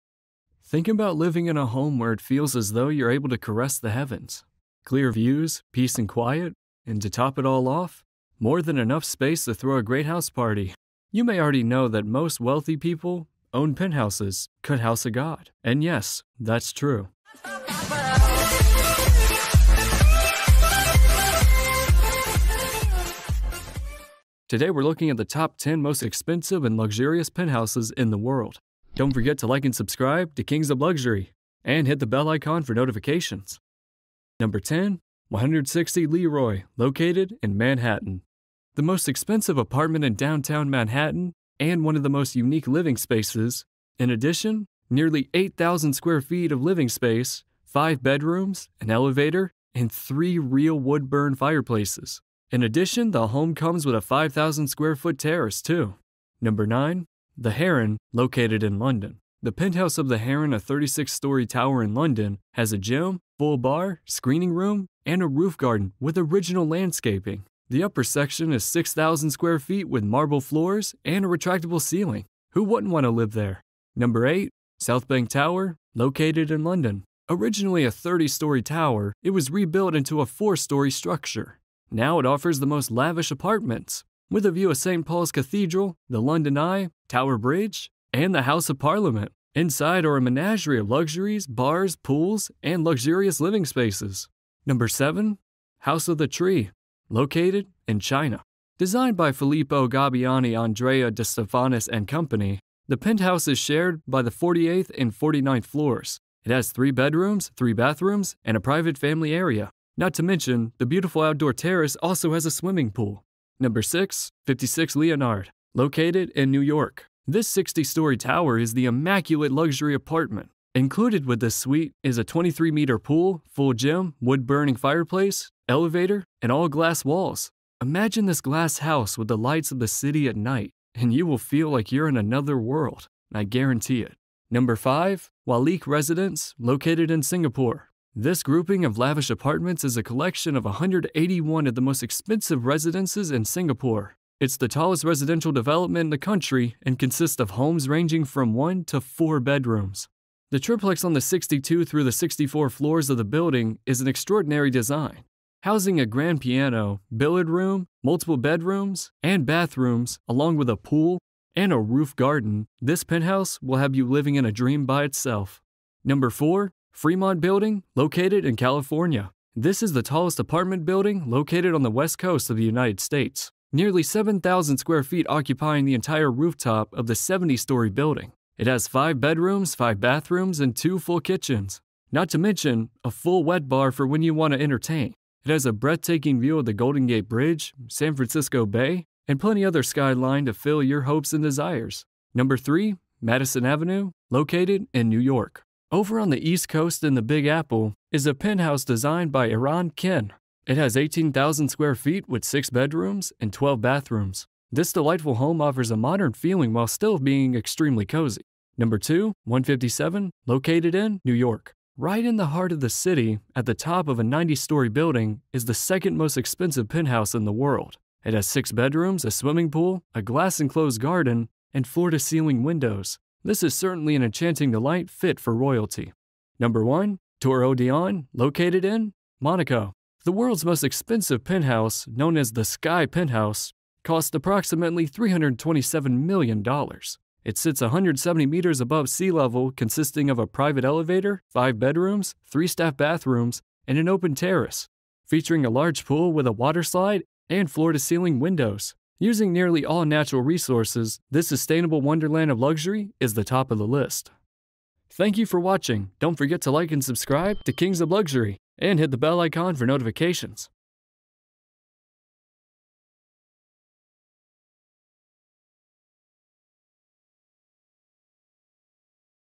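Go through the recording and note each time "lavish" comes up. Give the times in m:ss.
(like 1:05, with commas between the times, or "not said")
1:22, 2:18.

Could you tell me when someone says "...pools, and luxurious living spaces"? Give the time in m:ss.
1:31.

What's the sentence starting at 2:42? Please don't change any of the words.
This penthouse will have you living in a dream by itself.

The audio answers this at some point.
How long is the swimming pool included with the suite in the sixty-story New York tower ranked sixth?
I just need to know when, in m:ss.
2:02.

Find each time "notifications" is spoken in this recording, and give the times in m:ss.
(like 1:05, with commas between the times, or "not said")
0:32, 4:19.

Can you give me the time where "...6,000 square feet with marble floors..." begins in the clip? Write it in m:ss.
1:08.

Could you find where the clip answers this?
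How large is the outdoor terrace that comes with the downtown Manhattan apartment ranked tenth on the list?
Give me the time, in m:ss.
0:54.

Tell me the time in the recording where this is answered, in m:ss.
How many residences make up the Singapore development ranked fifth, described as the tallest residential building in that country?
2:20.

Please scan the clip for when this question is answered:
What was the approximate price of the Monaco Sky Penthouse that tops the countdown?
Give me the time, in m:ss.
3:55.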